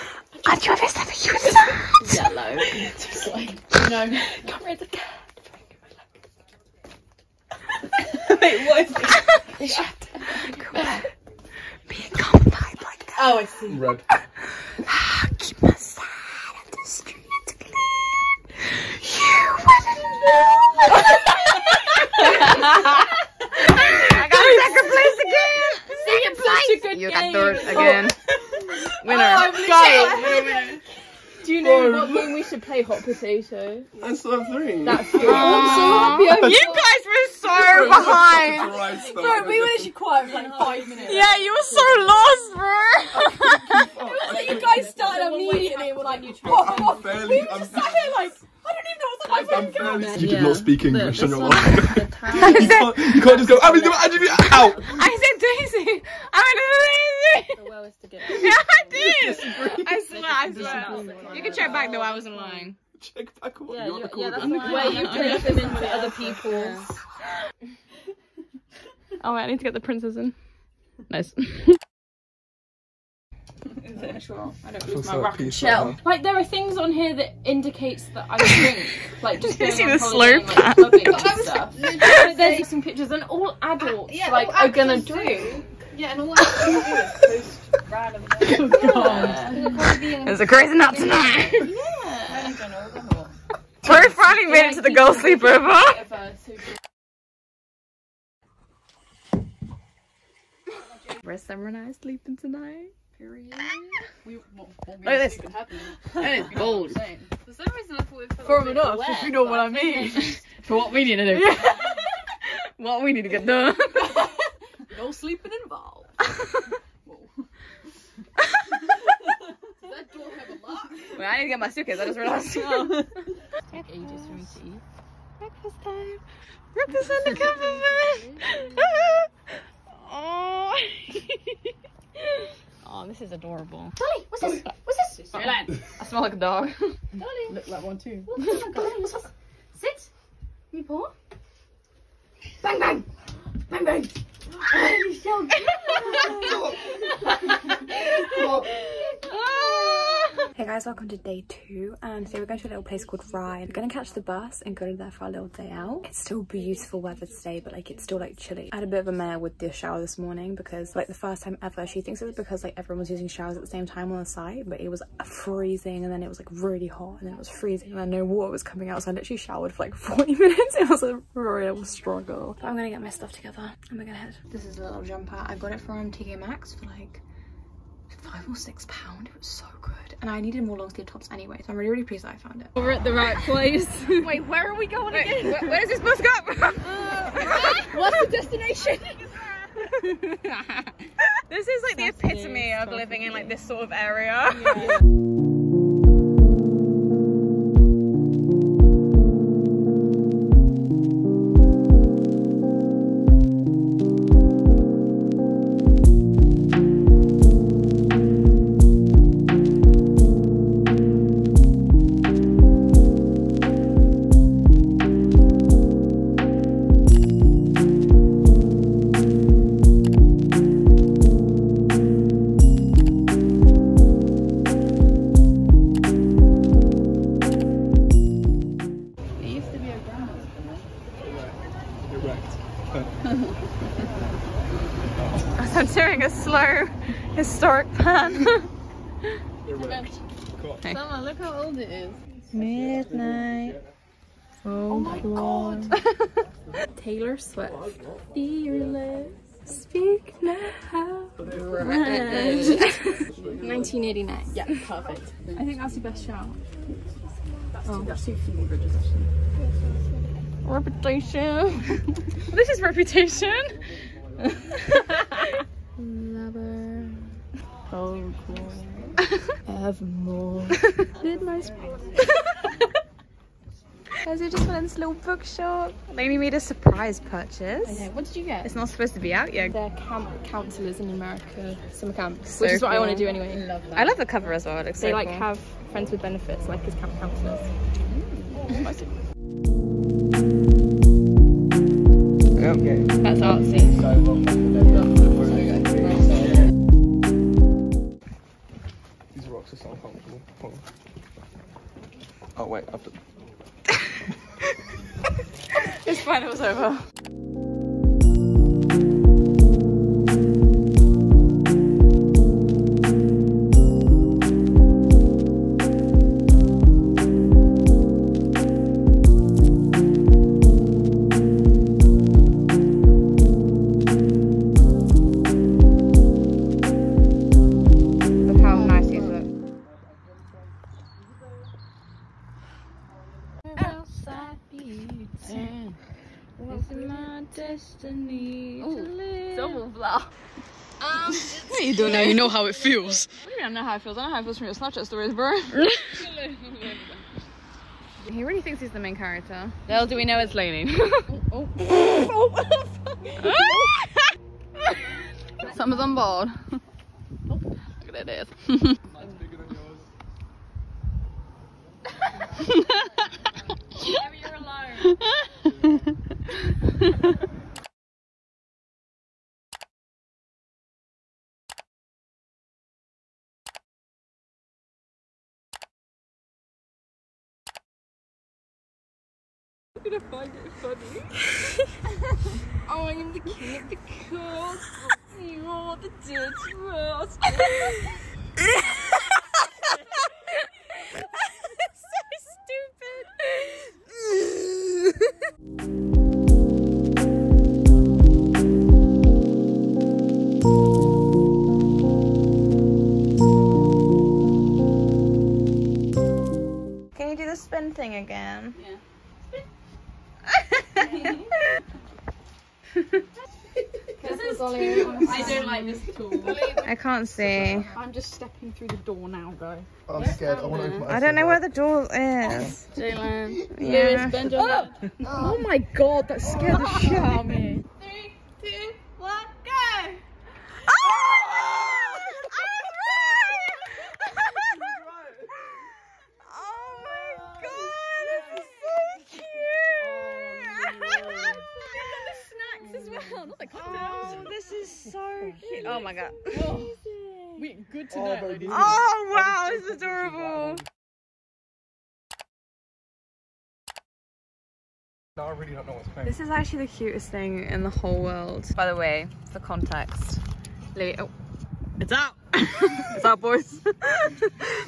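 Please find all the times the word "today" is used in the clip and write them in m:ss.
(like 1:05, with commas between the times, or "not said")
2:32, 2:37.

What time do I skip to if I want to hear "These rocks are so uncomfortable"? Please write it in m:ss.
4:59.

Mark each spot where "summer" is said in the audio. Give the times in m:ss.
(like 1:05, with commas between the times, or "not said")
1:41, 4:41, 5:55.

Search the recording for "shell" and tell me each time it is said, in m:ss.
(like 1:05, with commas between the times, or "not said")
1:15.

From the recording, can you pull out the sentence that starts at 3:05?
Where, where does this bus go?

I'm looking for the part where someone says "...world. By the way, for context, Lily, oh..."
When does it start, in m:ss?
7:38.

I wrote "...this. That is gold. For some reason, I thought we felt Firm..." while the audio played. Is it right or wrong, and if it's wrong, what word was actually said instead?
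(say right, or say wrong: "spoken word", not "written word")
right.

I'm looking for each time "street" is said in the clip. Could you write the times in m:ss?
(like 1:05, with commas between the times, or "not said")
0:16.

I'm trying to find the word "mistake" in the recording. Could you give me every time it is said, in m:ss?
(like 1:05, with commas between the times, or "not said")
not said.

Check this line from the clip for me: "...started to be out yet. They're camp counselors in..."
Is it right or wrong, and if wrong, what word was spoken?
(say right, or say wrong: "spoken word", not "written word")
wrong: "supposed", not "started".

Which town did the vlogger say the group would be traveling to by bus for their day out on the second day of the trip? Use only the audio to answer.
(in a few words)
Rye.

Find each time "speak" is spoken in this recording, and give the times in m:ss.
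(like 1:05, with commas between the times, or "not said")
0:50, 4:09.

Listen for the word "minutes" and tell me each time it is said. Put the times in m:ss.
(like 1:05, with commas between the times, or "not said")
0:40, 2:50.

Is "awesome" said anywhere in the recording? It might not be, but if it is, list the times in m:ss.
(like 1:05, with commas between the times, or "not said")
not said.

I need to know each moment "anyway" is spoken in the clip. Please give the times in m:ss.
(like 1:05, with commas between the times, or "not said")
3:01, 4:43.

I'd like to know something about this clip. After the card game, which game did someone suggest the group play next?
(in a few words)
Hot potato.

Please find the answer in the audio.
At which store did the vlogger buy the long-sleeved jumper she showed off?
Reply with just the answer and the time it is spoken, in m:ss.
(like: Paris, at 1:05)
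TK Maxx, at 2:56.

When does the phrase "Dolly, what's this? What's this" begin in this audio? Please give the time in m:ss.
2:13.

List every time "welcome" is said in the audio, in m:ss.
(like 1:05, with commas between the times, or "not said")
2:30.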